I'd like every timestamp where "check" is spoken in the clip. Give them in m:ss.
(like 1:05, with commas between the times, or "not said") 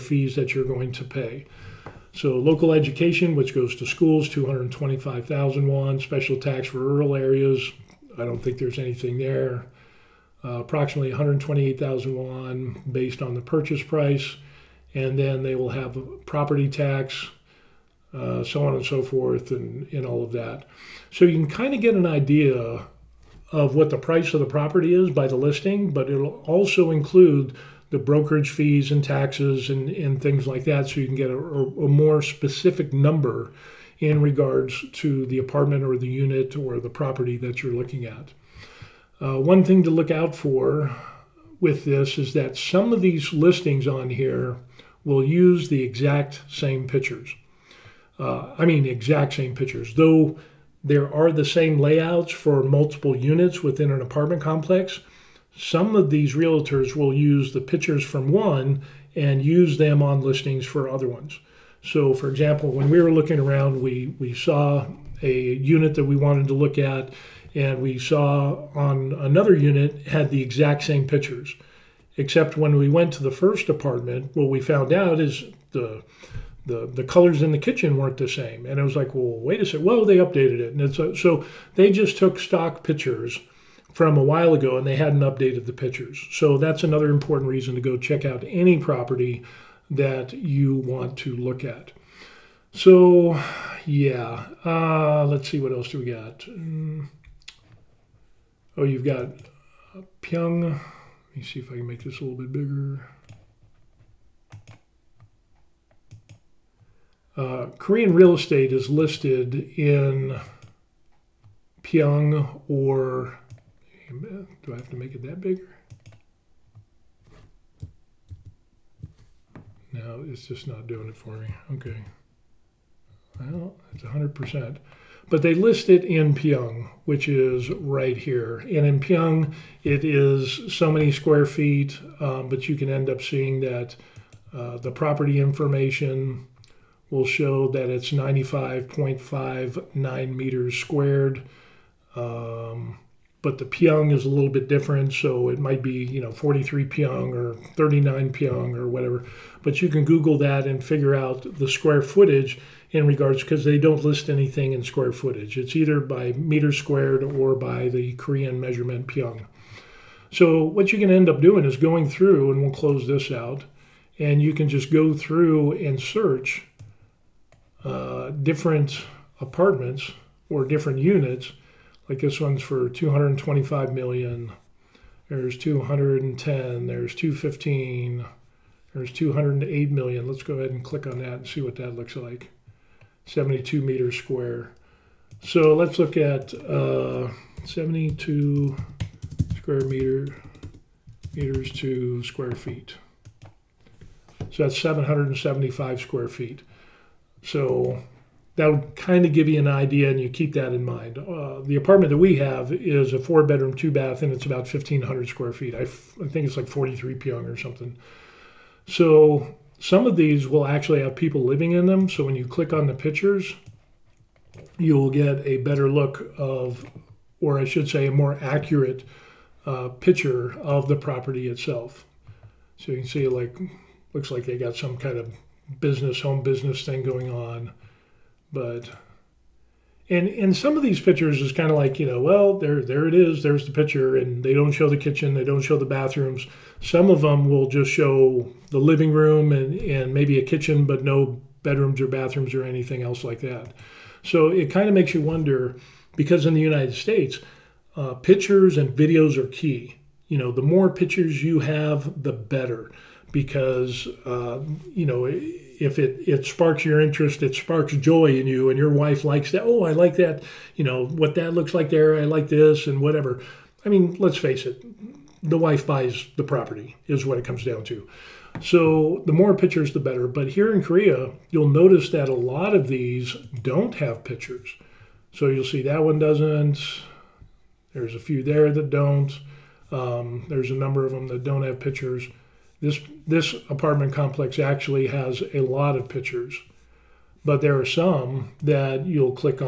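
1:27.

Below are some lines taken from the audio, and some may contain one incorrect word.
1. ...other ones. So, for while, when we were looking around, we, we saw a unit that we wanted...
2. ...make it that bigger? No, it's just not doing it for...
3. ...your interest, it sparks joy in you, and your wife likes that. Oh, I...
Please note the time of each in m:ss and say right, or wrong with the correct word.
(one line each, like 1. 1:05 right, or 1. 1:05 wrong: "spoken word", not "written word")
1. 1:00 wrong: "example", not "while"
2. 1:54 right
3. 4:16 right.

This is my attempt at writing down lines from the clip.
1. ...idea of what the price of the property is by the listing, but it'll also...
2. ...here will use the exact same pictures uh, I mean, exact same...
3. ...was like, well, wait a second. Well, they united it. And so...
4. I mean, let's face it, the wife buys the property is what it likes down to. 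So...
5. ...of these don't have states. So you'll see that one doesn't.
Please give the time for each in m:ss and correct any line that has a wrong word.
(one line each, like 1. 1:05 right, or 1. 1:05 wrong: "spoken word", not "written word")
1. 0:22 right
2. 0:44 right
3. 1:18 wrong: "updated", not "united"
4. 4:23 wrong: "comes", not "likes"
5. 4:32 wrong: "pictures", not "states".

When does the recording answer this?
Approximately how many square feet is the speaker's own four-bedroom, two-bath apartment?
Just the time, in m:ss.
3:24.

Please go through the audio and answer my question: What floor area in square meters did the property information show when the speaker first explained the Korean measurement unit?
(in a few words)
95.59 square meters.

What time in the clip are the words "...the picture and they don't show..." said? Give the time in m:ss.
3:53.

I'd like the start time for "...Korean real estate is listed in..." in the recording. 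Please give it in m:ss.
1:47.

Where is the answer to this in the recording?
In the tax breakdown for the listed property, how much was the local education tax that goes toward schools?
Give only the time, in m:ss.
0:04.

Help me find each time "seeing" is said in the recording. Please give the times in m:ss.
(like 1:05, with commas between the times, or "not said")
2:13.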